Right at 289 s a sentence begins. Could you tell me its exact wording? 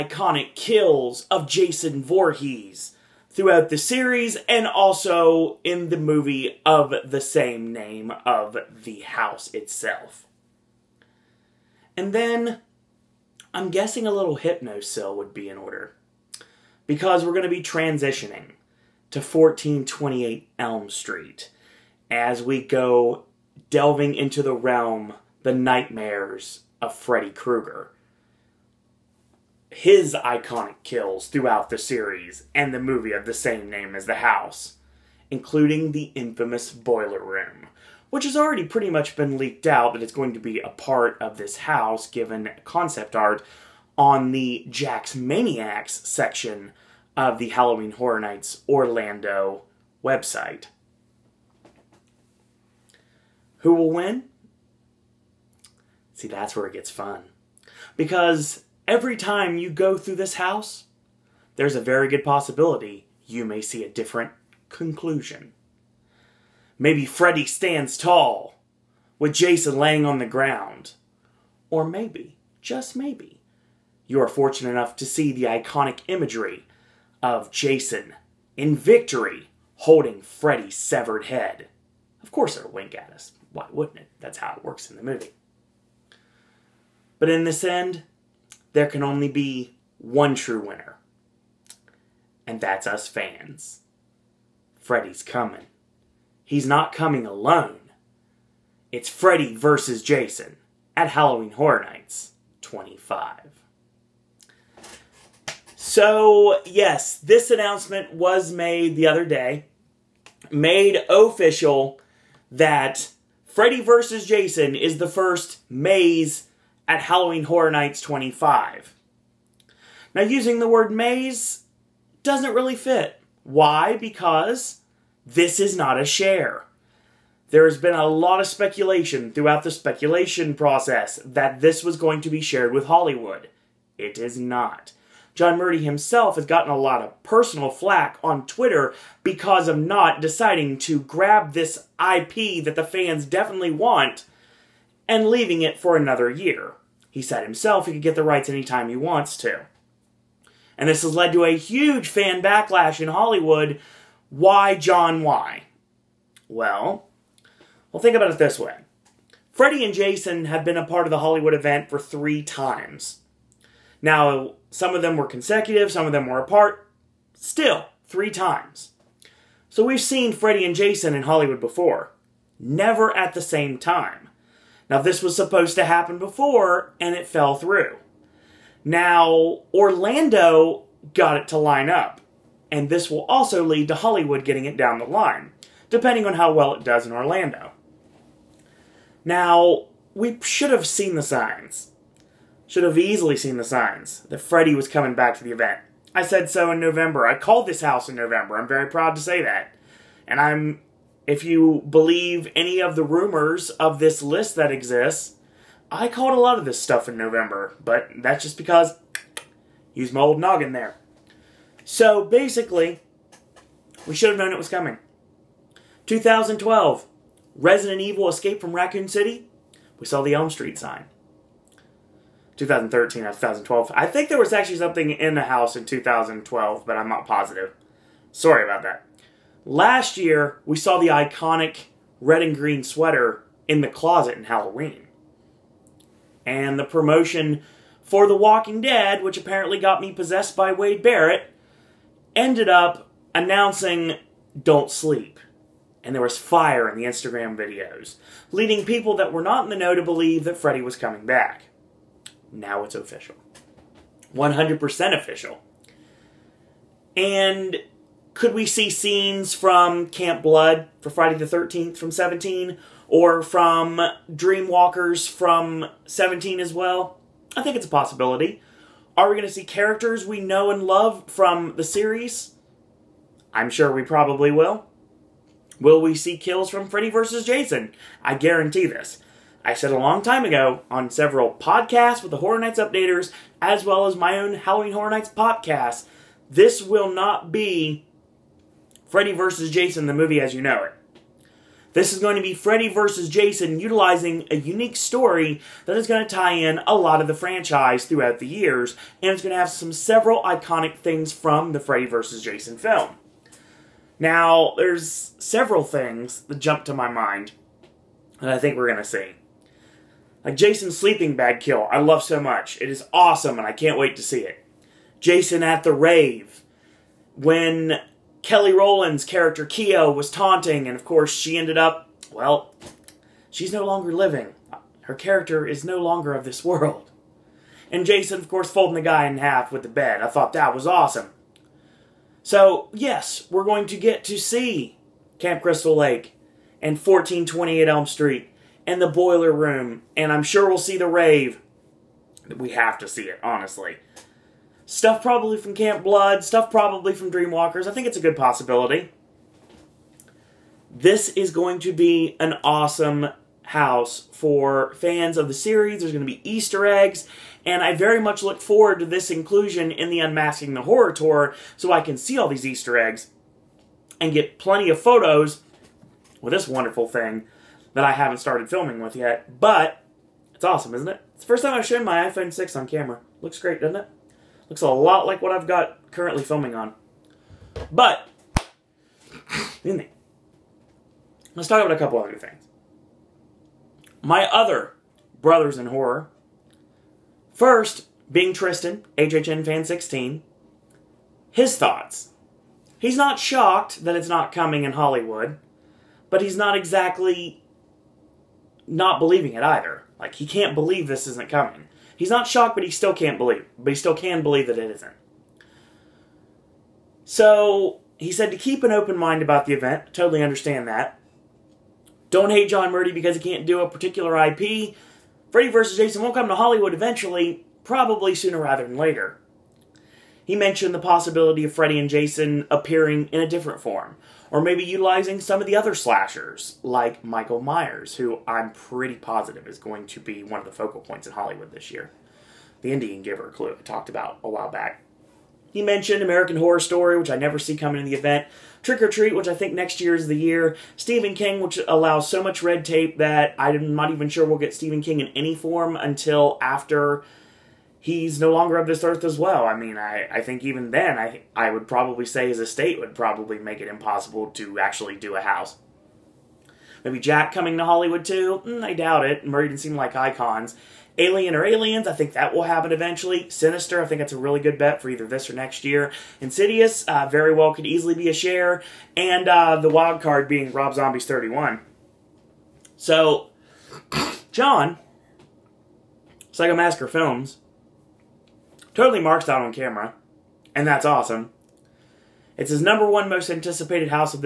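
Jason, the movie as you know it.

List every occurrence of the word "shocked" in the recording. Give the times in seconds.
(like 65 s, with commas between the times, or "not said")
393 s, 402 s.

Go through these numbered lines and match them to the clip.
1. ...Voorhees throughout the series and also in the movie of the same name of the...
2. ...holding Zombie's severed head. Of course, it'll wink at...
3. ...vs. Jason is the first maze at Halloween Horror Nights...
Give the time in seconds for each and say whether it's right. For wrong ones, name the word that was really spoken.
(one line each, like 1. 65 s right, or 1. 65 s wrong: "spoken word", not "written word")
1. 2 s right
2. 79 s wrong: "Freddy", not "Zombie"
3. 113 s right.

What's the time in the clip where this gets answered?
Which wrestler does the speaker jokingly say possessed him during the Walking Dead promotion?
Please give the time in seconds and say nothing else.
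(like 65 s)
240 s.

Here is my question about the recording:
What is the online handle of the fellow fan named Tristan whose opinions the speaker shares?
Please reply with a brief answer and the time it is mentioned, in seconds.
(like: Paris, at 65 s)
HHN fan 16, at 389 s.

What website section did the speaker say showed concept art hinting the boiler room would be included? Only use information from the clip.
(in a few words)
Jack's Maniacs.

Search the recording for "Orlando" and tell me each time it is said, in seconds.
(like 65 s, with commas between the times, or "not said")
48 s, 179 s, 187 s.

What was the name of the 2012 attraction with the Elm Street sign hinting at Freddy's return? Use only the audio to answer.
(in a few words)
Resident Evil Escape from Raccoon City.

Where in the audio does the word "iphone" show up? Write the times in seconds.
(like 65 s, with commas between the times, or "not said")
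372 s.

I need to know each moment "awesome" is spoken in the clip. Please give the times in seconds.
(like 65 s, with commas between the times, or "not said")
313 s, 330 s, 352 s, 370 s, 481 s.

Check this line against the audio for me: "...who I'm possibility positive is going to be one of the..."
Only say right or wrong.
wrong.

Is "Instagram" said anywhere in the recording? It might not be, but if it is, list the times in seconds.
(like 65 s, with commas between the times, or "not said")
247 s.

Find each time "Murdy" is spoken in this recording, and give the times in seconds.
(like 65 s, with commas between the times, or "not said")
135 s, 412 s, 459 s.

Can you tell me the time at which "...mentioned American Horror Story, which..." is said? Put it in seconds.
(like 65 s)
435 s.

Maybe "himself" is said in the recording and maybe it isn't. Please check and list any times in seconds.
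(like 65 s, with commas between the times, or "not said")
135 s, 147 s.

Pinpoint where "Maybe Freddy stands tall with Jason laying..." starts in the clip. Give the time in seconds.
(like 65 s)
66 s.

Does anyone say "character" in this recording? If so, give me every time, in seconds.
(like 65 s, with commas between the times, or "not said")
269 s, 319 s, 325 s.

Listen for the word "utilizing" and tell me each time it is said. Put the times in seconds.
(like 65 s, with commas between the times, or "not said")
293 s, 424 s.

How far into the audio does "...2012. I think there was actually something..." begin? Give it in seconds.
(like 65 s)
223 s.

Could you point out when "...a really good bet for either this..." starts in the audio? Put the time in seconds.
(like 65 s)
464 s.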